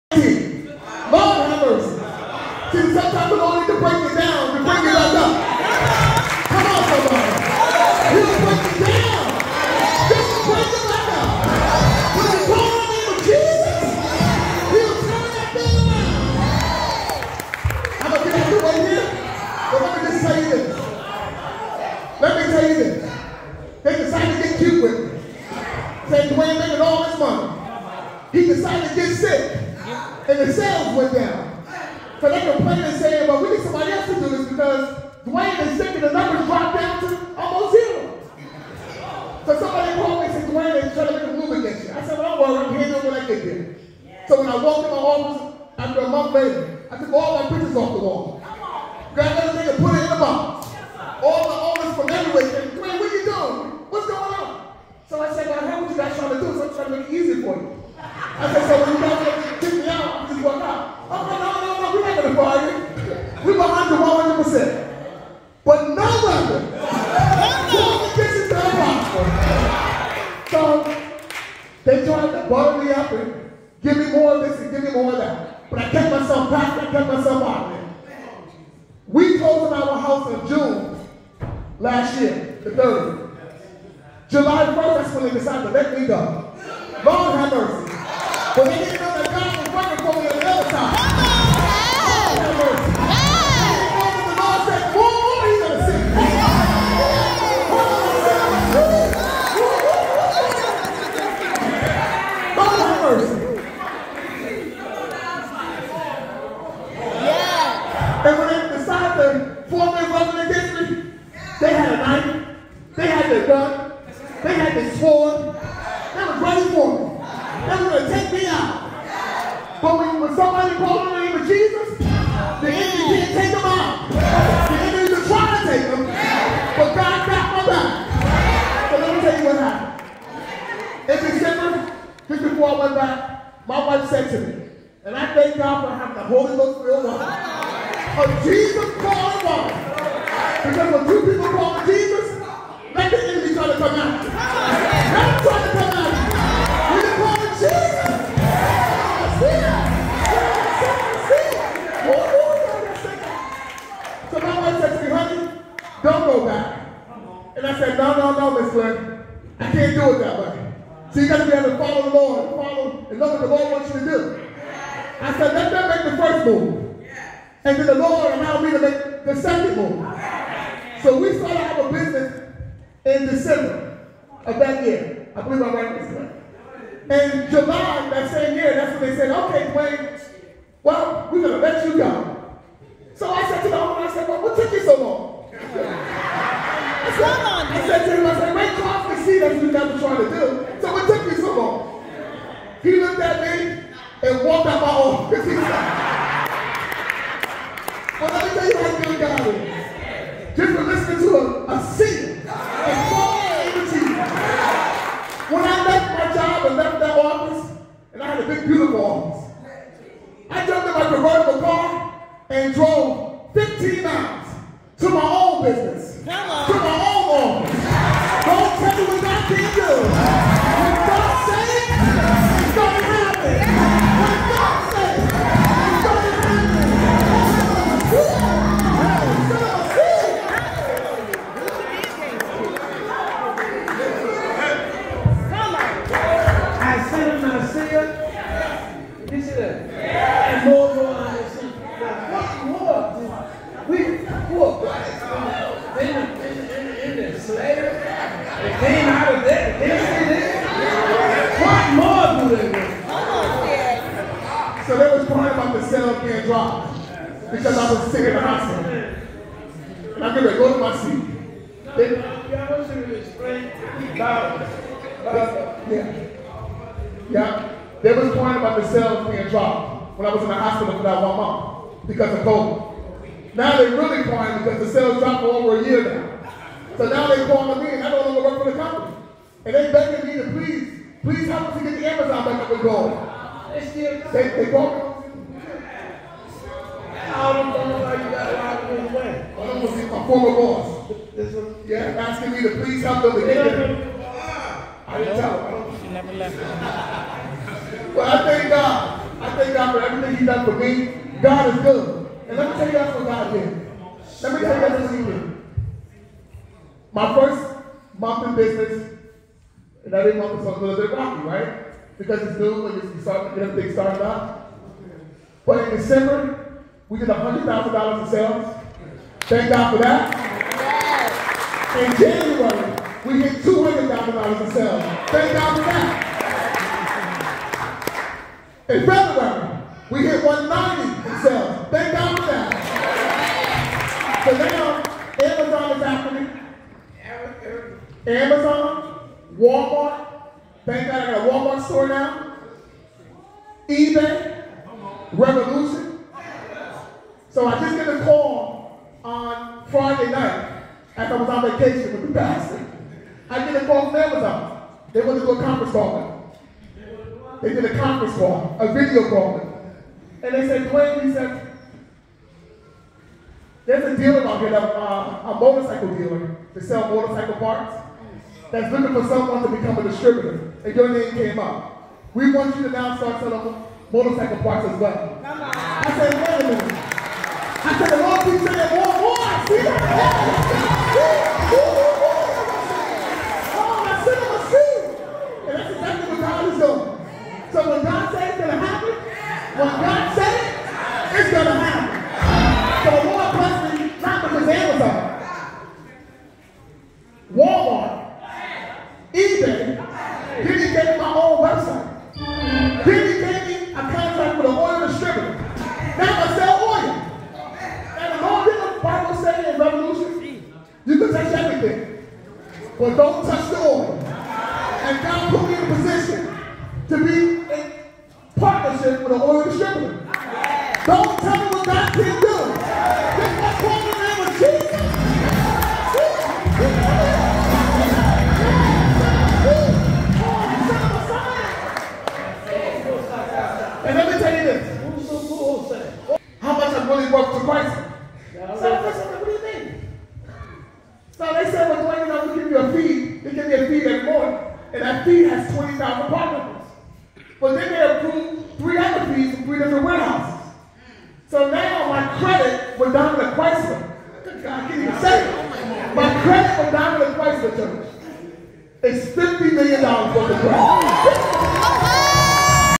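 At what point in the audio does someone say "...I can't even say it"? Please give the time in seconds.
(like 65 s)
454 s.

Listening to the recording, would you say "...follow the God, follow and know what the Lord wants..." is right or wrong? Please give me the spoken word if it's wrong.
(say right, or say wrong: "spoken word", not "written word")
wrong: "Lord", not "God".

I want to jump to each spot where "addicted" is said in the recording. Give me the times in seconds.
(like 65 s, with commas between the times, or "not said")
not said.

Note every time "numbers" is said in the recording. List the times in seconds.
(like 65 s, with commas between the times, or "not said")
1 s, 36 s.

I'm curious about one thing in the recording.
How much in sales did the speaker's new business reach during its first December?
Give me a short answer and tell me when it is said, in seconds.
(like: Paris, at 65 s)
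$100,000, at 317 s.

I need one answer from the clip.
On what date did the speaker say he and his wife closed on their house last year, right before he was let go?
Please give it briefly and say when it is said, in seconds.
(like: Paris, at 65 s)
June 30, at 80 s.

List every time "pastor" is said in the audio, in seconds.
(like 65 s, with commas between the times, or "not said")
352 s.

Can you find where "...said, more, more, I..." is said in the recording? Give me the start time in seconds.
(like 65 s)
378 s.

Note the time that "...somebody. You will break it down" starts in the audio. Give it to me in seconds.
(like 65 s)
6 s.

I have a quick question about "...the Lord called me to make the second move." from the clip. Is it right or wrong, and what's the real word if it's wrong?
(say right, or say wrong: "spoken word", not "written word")
wrong: "allowed", not "called".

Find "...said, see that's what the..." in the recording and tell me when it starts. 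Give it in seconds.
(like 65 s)
188 s.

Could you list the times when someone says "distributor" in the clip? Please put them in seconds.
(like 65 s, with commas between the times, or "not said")
370 s, 419 s.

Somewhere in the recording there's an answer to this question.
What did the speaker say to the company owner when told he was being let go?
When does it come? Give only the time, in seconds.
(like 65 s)
184 s.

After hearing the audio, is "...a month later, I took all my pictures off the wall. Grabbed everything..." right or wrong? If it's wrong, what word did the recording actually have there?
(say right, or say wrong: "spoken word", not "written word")
right.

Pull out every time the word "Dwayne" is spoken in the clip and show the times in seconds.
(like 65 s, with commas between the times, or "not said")
26 s, 35 s, 40 s, 52 s, 179 s, 360 s.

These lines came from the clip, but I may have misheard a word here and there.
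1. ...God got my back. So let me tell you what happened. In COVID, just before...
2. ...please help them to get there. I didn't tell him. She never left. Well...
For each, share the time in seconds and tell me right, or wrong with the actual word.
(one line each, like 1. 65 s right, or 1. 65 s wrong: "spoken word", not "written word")
1. 126 s wrong: "December", not "COVID"
2. 292 s right.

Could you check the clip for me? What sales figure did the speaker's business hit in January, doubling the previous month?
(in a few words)
$200,000.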